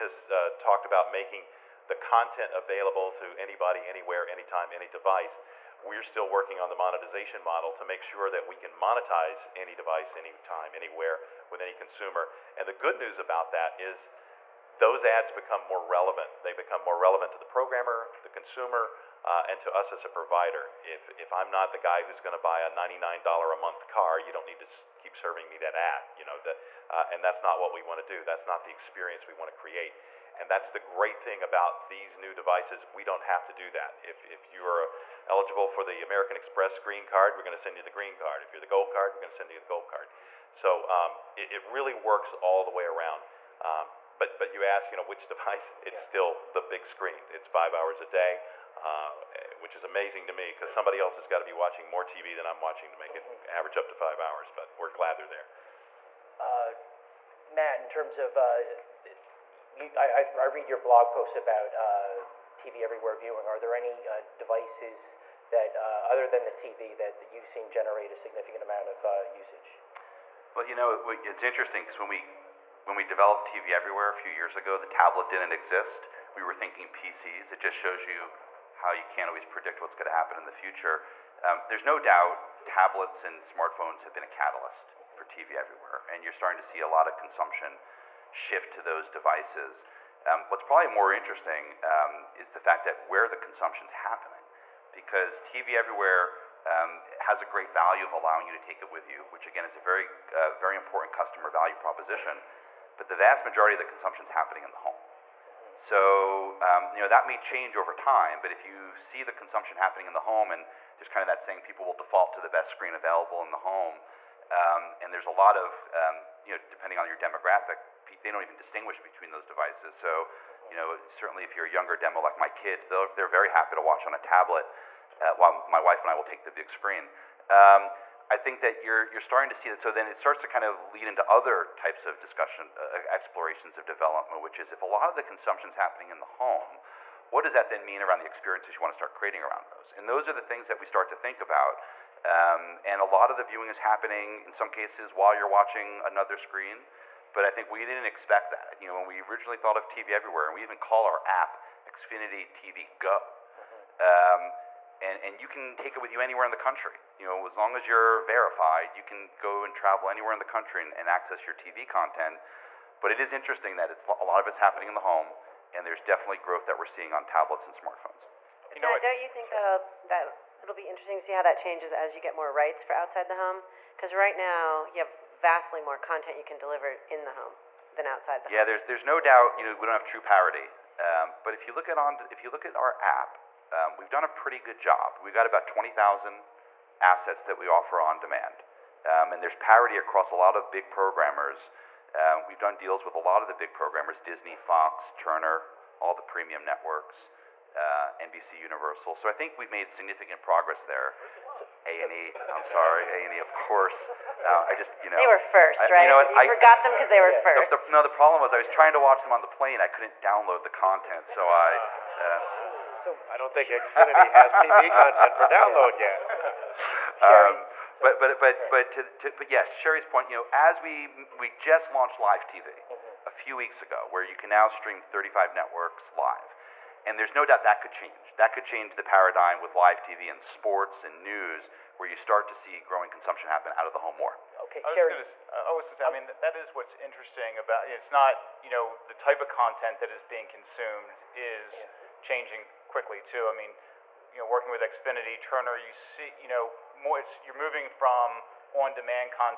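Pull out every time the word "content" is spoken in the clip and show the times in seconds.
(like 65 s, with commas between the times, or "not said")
1 s, 161 s, 175 s, 210 s, 214 s, 239 s.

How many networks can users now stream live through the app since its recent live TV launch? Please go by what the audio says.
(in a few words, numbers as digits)
35.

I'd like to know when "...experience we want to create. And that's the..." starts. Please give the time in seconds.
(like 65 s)
28 s.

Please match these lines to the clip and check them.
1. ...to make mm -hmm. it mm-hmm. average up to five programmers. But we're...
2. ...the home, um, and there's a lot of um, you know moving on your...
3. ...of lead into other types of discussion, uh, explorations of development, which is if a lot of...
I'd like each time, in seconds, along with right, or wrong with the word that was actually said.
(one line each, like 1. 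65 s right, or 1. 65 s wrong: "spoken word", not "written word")
1. 52 s wrong: "hours", not "programmers"
2. 113 s wrong: "depending", not "moving"
3. 130 s right.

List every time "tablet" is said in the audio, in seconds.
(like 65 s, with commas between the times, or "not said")
74 s, 82 s, 124 s, 167 s.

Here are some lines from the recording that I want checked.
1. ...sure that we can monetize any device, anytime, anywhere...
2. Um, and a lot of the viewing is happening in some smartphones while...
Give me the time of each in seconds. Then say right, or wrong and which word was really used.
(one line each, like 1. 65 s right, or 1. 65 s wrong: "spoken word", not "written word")
1. 8 s right
2. 142 s wrong: "cases", not "smartphones".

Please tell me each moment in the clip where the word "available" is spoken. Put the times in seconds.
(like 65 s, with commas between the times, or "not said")
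2 s, 112 s.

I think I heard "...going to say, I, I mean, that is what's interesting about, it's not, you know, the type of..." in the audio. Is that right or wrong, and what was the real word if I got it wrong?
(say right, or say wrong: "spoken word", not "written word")
right.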